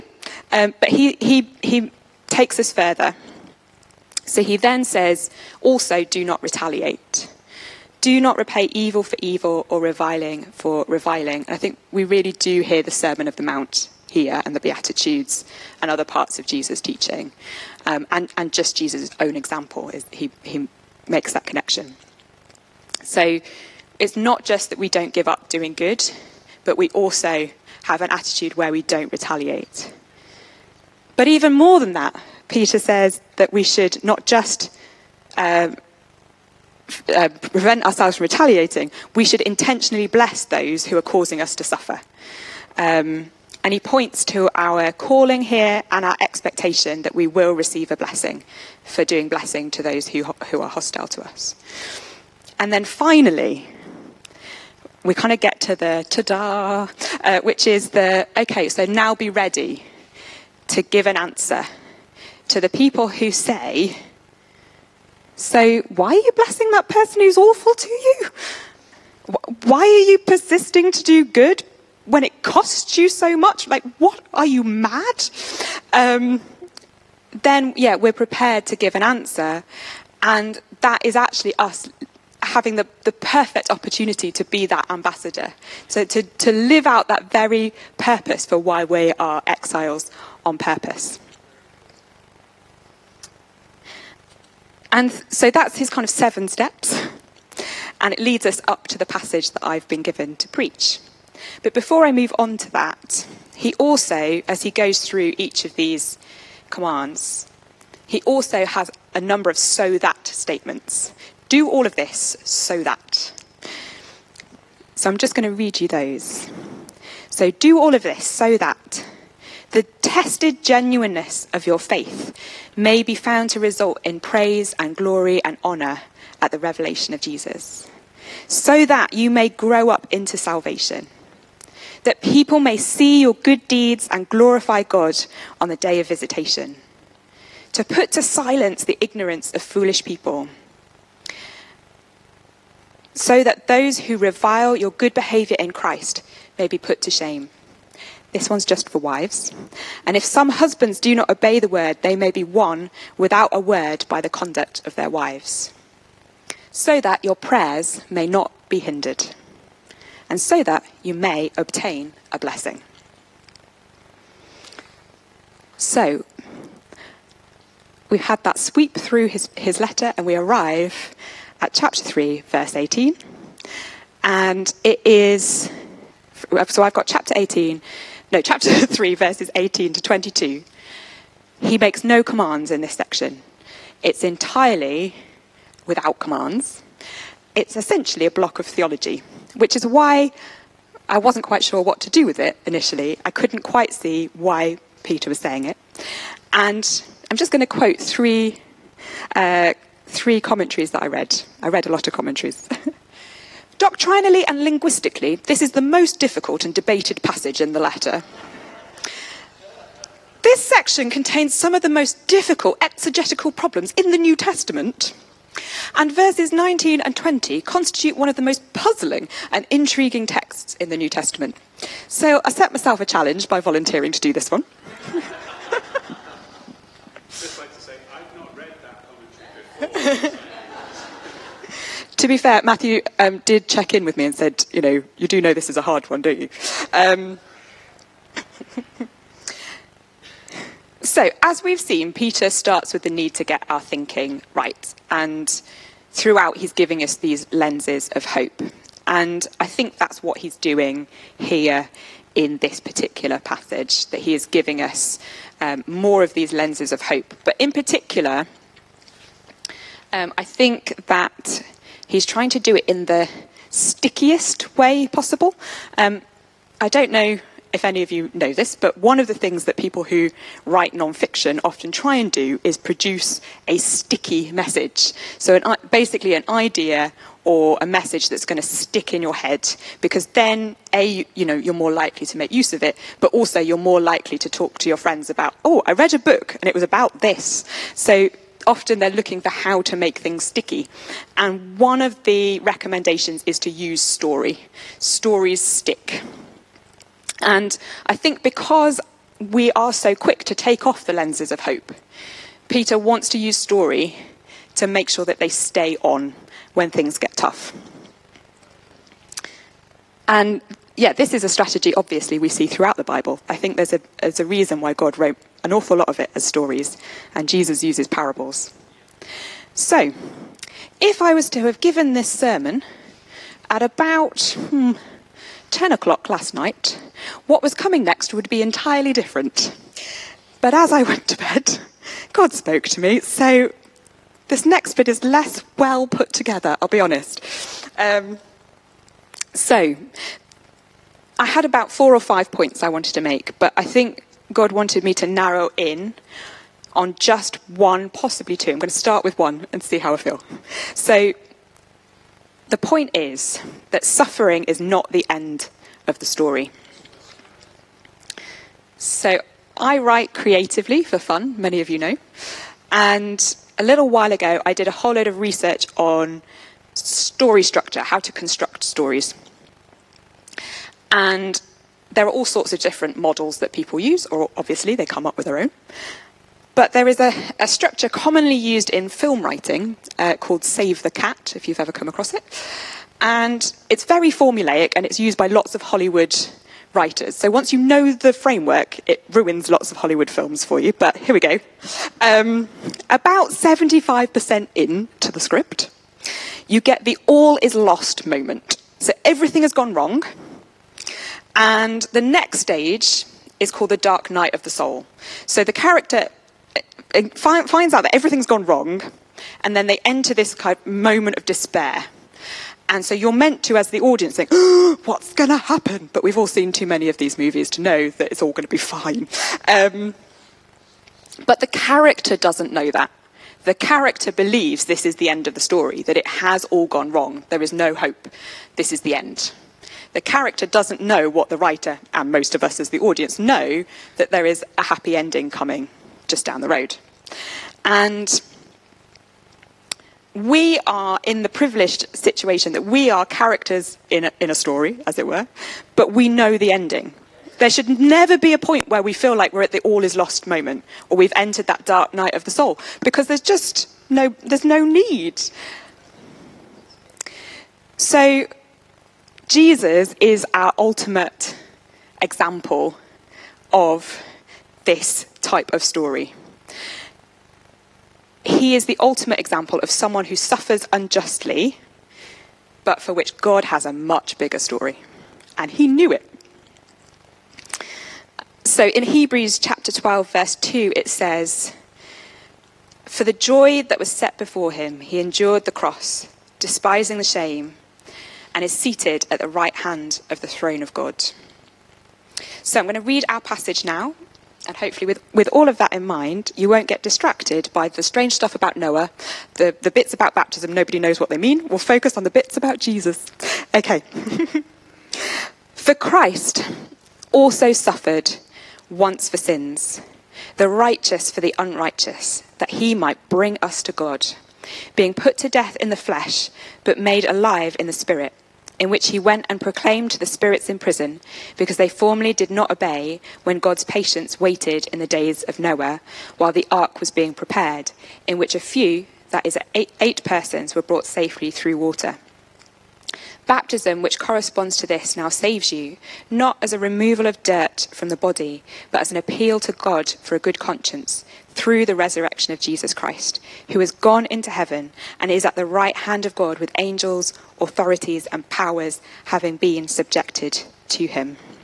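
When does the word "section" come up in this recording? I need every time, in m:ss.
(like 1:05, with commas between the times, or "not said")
3:02, 3:30.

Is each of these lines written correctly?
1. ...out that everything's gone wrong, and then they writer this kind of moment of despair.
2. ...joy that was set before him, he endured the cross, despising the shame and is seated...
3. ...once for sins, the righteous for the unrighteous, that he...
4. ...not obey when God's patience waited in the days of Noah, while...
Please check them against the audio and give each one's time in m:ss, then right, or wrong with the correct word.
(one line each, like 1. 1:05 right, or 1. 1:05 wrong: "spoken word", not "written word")
1. 6:47 wrong: "enter", not "writer"
2. 8:03 right
3. 8:28 right
4. 8:42 right.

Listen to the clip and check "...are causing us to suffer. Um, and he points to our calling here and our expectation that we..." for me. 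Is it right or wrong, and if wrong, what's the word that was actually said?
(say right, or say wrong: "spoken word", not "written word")
right.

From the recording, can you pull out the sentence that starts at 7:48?
He is the ultimate example of someone who suffers unjustly, but for which God has a much bigger story.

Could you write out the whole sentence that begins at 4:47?
So, often they're looking for how to make things sticky.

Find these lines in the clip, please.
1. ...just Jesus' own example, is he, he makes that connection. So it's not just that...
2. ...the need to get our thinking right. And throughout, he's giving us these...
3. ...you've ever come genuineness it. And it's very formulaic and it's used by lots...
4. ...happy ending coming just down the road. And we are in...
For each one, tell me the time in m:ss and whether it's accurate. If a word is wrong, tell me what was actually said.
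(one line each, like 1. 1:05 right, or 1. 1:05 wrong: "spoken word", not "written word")
1. 0:18 right
2. 4:03 right
3. 6:21 wrong: "across", not "genuineness"
4. 7:14 right.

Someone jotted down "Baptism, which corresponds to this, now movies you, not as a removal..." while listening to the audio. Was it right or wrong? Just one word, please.
wrong.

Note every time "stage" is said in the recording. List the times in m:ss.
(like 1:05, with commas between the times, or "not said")
6:42.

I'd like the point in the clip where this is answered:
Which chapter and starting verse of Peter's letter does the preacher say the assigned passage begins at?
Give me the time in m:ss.
2:51.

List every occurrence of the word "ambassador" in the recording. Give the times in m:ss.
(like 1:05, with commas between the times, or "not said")
1:24.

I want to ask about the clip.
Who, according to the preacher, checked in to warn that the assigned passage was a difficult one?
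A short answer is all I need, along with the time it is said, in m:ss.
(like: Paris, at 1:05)
Matthew, at 3:52.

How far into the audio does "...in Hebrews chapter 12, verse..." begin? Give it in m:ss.
7:58.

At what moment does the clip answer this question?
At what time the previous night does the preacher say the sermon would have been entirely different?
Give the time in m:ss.
5:25.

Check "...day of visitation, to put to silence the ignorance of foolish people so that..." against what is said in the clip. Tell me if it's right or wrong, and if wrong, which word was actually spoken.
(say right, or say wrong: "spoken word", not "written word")
right.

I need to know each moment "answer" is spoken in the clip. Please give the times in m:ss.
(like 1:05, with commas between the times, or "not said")
1:01, 1:19.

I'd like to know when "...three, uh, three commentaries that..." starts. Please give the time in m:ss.
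3:17.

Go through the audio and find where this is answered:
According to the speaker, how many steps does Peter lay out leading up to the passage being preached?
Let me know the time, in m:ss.
1:36.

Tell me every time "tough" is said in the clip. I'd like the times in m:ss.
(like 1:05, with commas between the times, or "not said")
5:07.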